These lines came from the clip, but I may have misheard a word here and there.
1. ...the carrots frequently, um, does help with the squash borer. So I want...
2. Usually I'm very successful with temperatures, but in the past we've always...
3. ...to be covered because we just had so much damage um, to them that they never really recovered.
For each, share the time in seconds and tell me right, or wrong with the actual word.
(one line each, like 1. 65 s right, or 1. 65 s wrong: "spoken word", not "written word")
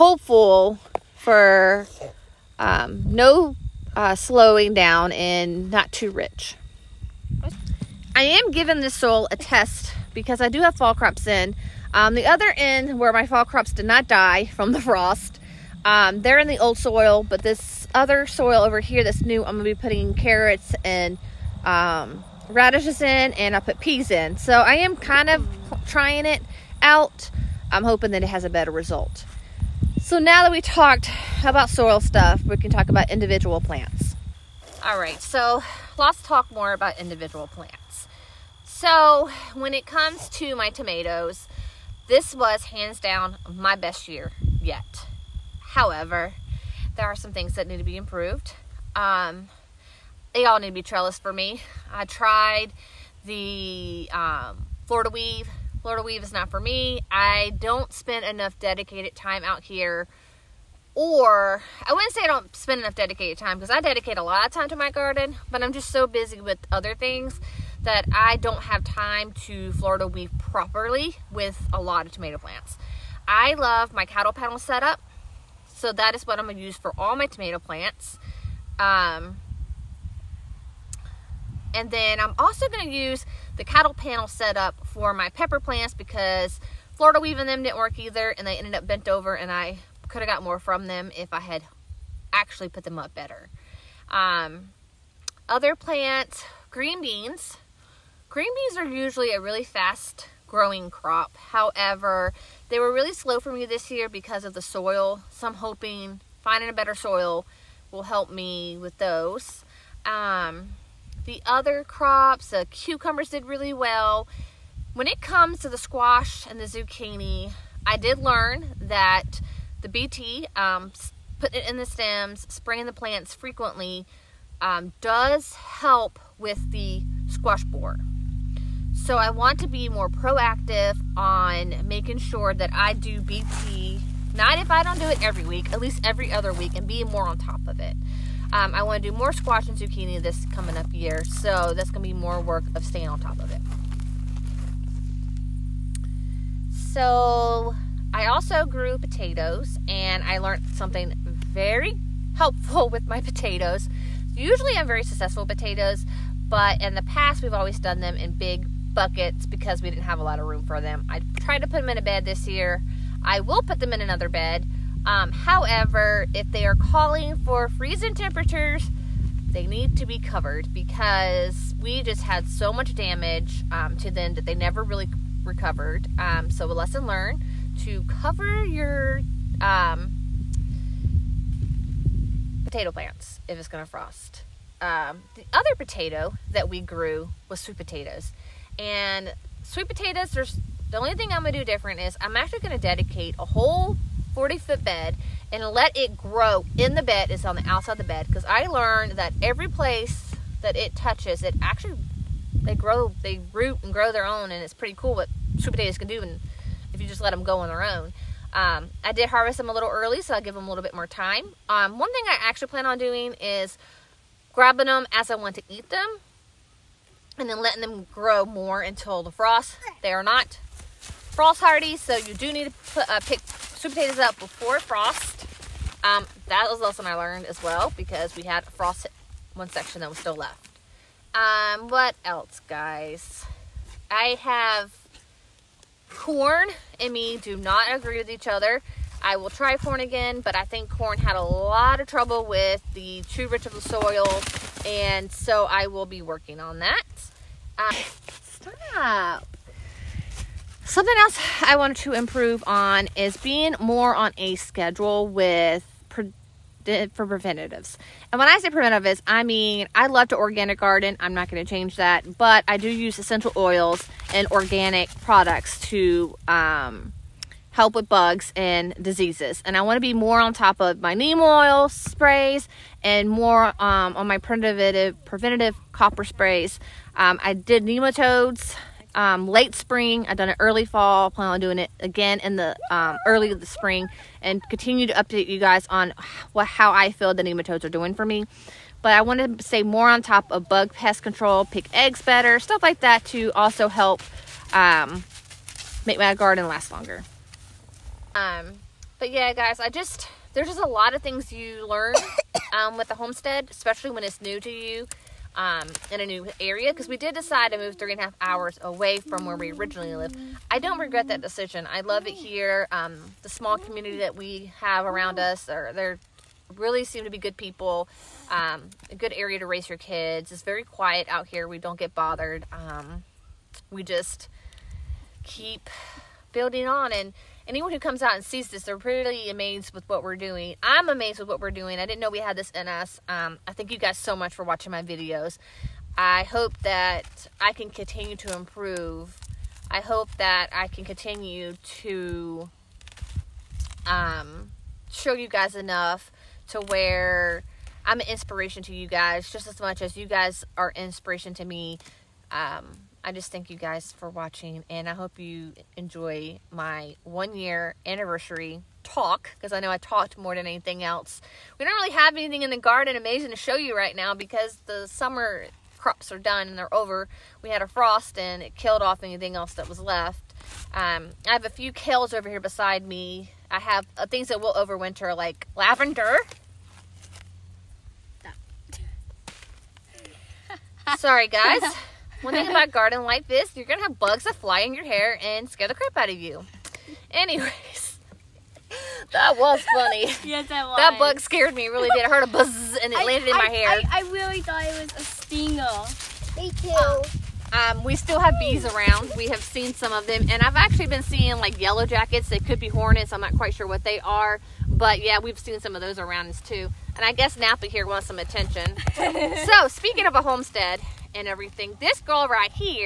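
1. 122 s wrong: "plants", not "carrots"
2. 154 s wrong: "potatoes", not "temperatures"
3. 169 s right.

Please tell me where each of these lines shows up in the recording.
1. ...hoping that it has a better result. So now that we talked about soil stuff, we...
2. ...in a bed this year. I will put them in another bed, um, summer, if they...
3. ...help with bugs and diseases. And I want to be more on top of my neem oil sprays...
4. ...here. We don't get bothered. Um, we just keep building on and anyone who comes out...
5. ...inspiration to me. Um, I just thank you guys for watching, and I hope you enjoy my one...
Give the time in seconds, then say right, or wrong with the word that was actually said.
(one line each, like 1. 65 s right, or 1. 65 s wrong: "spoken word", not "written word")
1. 27 s right
2. 161 s wrong: "however", not "summer"
3. 267 s right
4. 321 s right
5. 350 s right.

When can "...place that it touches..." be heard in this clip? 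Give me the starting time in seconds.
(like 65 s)
199 s.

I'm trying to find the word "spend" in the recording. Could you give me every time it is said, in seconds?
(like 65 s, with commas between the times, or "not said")
57 s, 62 s.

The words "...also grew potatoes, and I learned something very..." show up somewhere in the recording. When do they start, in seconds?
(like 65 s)
148 s.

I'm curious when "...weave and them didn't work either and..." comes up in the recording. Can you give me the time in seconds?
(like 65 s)
87 s.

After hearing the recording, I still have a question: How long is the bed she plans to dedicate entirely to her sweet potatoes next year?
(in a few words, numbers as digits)
40 feet.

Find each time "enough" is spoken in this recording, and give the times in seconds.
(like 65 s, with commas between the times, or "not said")
58 s, 62 s, 345 s.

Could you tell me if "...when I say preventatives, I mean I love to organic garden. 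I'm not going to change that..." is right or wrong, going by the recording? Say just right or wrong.
right.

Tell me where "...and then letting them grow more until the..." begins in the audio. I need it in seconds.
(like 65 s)
217 s.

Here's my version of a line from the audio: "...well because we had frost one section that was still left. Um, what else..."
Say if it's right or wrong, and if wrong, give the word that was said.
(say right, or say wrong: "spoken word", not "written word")
right.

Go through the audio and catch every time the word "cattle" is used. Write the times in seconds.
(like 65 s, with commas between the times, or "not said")
74 s, 83 s.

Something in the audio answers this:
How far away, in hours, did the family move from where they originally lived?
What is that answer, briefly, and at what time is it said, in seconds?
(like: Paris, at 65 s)
3.5 hours, at 307 s.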